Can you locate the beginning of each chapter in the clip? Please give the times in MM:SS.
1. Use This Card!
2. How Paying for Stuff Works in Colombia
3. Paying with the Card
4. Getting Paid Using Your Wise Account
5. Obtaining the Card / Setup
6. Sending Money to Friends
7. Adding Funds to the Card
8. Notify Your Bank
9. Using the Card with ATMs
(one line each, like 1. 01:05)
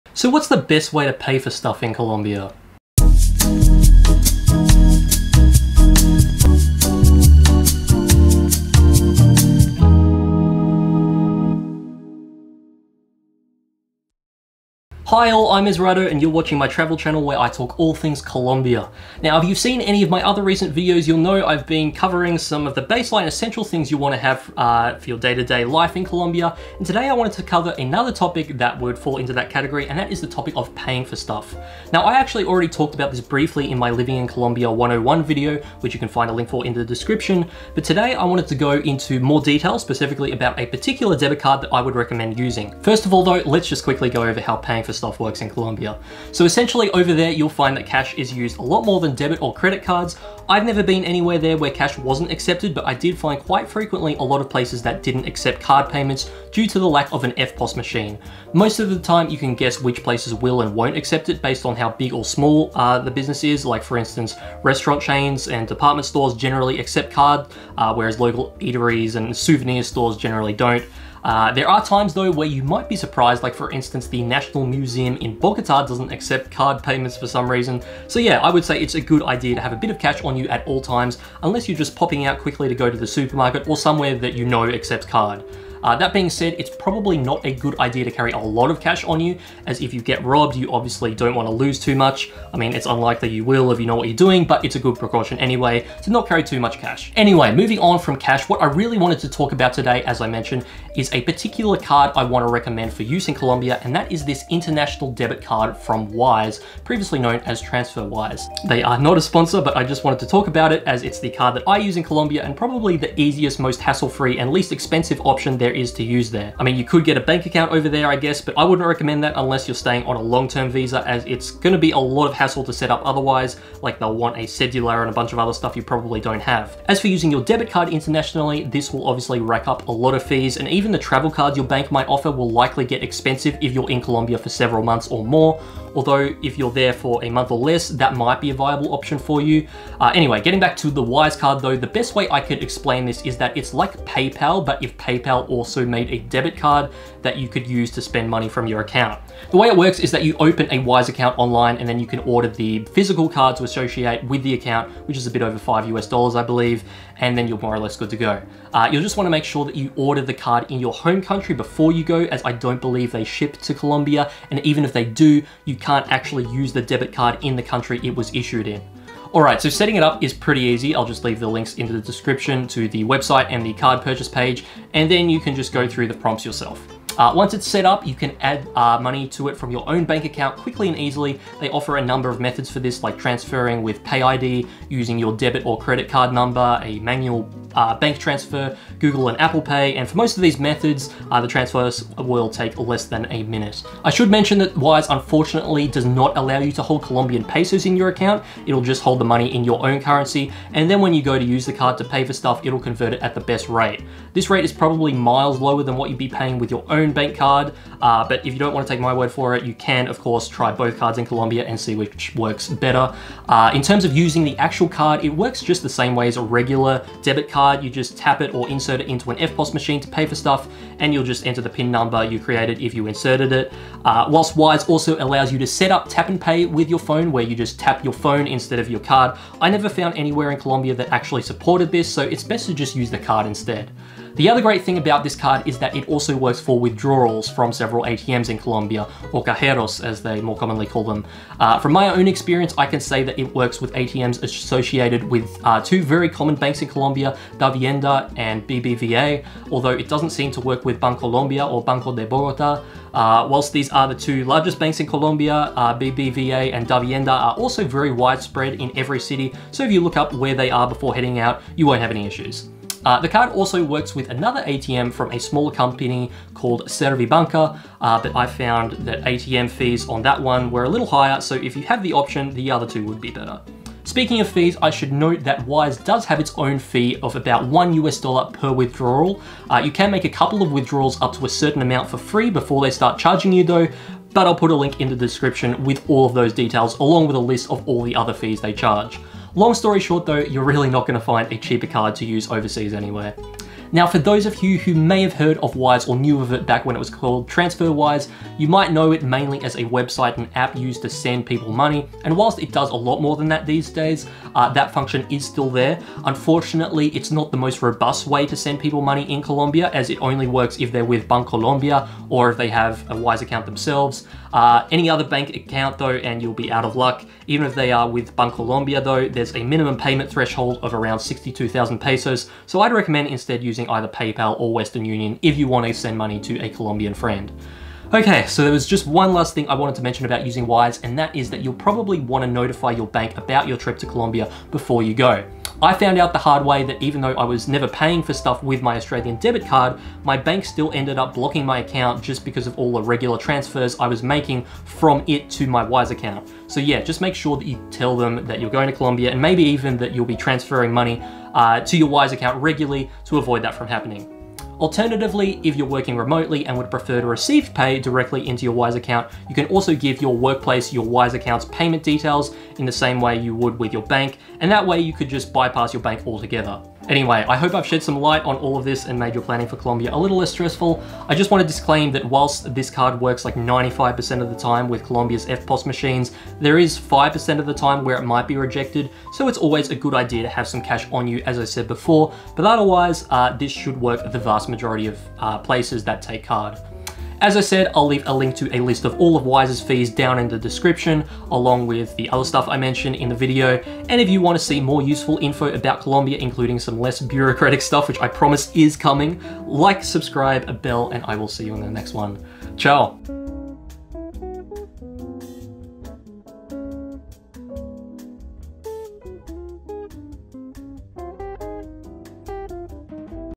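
1. 01:37
2. 00:42
3. 03:33
4. 05:54
5. 02:29
6. 04:53
7. 02:57
8. 05:28
9. 03:54.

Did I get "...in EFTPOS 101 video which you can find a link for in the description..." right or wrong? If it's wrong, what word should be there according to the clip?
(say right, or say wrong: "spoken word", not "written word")
wrong: "Colombia", not "EFTPOS".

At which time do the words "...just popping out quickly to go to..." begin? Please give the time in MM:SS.
01:21.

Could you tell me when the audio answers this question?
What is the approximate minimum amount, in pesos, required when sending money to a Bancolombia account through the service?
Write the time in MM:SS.
05:21.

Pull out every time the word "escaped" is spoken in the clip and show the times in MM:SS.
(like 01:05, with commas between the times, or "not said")
not said.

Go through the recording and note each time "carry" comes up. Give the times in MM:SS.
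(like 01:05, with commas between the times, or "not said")
01:28, 01:36.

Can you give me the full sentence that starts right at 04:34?
Speaking of fees, I should note that Wise does have its own fee of about one US dollar per withdrawal.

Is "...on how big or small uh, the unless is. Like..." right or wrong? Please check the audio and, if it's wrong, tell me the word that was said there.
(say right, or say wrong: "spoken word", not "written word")
wrong: "business", not "unless".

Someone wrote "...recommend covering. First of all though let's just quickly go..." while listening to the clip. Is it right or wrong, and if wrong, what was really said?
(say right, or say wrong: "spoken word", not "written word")
wrong: "using", not "covering".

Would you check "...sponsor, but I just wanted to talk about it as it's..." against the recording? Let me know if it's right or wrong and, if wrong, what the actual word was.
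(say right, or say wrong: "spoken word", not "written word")
right.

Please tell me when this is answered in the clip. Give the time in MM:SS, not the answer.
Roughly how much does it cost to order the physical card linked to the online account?
02:35.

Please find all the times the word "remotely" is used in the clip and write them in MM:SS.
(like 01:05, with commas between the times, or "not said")
05:56.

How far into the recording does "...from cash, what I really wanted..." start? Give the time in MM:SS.
01:37.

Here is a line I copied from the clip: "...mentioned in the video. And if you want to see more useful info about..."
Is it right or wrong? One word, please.
right.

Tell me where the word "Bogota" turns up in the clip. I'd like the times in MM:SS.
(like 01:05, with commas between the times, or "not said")
01:15, 04:12.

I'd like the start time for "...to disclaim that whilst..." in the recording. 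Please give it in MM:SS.
06:11.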